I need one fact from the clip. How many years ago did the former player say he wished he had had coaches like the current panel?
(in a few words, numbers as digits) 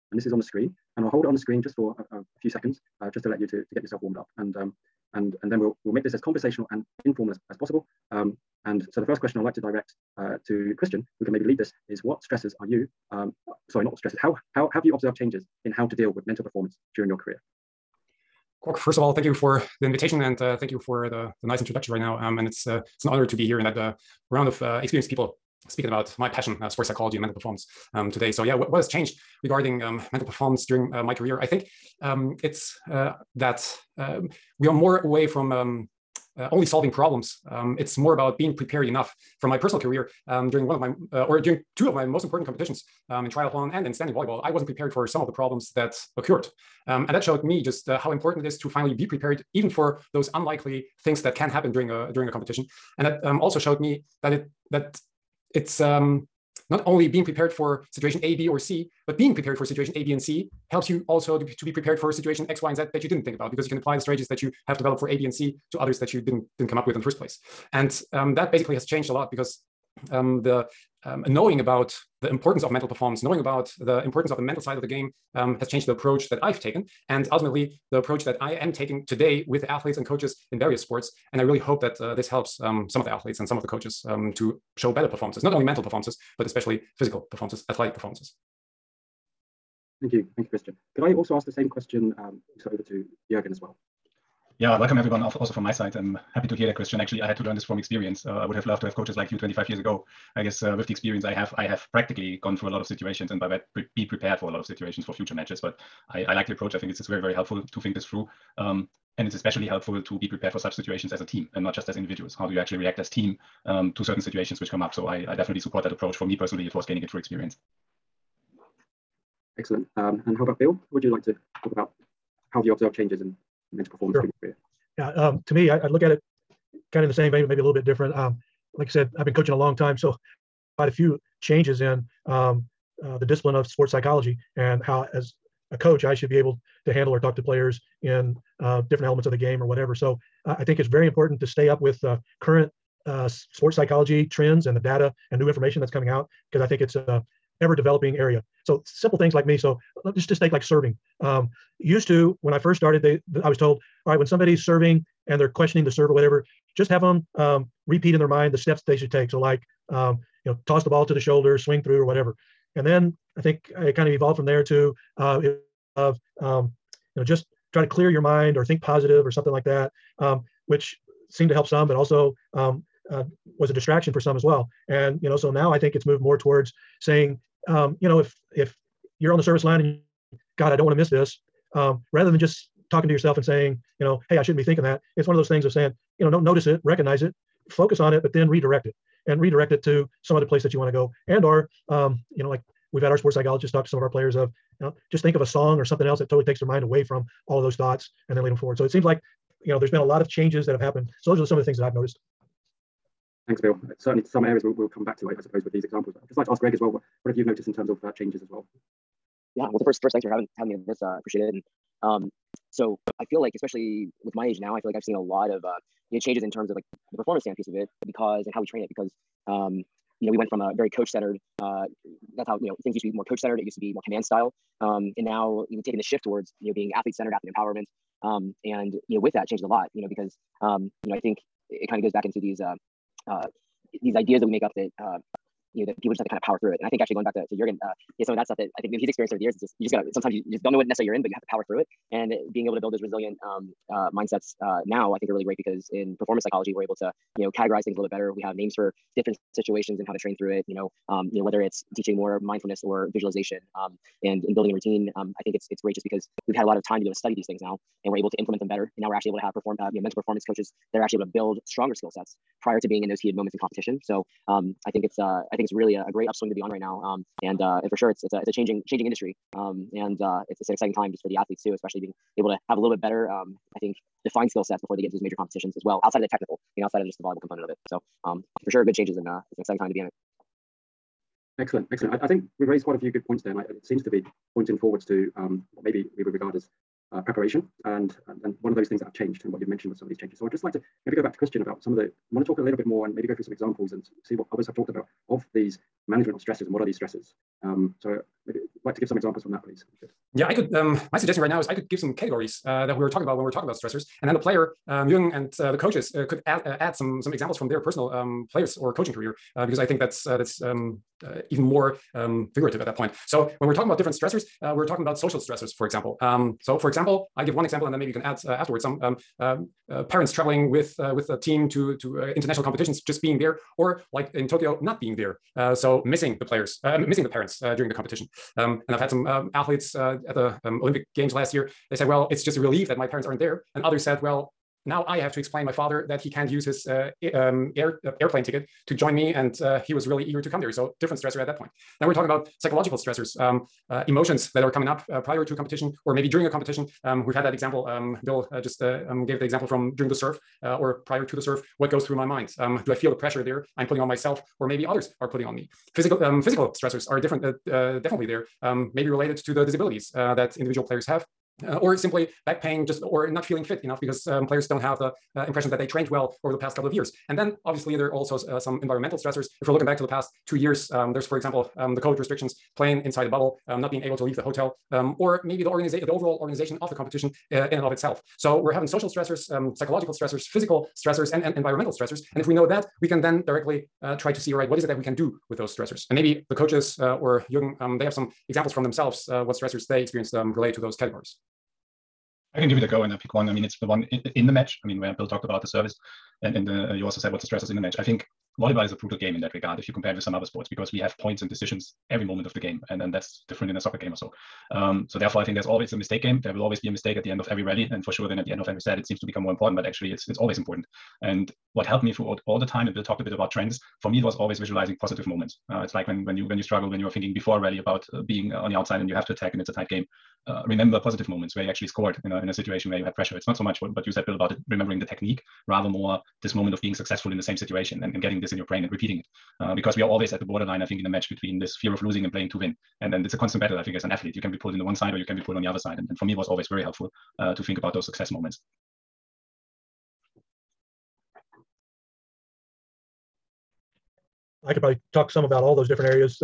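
25.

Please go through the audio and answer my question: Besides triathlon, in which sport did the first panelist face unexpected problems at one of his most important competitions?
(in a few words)
standing volleyball.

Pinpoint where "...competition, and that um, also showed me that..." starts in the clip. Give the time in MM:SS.
00:52.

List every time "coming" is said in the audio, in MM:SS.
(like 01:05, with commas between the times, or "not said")
02:25, 05:44.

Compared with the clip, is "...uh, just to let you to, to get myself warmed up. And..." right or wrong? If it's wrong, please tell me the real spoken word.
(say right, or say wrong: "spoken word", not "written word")
wrong: "yourself", not "myself".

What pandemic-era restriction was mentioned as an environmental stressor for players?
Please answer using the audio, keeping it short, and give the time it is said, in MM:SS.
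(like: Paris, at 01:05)
playing inside a bubble, at 06:12.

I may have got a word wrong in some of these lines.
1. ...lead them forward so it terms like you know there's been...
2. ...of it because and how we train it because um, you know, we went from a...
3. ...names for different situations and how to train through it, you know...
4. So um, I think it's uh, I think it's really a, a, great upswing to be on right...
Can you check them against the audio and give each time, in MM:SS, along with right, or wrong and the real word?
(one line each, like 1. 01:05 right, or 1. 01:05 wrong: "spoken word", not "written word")
1. 03:18 wrong: "seems", not "terms"
2. 03:37 right
3. 04:08 right
4. 04:24 right.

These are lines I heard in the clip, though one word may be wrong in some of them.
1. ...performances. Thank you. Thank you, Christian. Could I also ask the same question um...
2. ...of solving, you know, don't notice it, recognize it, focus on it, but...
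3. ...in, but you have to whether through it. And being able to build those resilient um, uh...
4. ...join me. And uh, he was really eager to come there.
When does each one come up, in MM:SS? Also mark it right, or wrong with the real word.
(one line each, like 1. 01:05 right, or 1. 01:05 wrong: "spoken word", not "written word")
1. 01:27 right
2. 03:05 wrong: "saying", not "solving"
3. 04:01 wrong: "power", not "whether"
4. 05:38 right.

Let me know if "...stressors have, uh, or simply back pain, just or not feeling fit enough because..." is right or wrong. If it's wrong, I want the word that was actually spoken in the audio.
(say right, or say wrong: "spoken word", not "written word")
wrong: "players", not "stressors".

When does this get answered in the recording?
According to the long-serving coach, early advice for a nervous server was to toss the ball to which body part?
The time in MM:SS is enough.
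02:41.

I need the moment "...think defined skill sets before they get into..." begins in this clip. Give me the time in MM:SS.
04:33.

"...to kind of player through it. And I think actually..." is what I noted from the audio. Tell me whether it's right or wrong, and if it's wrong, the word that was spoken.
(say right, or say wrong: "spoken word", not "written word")
wrong: "power", not "player".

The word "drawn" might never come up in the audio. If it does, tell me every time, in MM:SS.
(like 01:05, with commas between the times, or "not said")
not said.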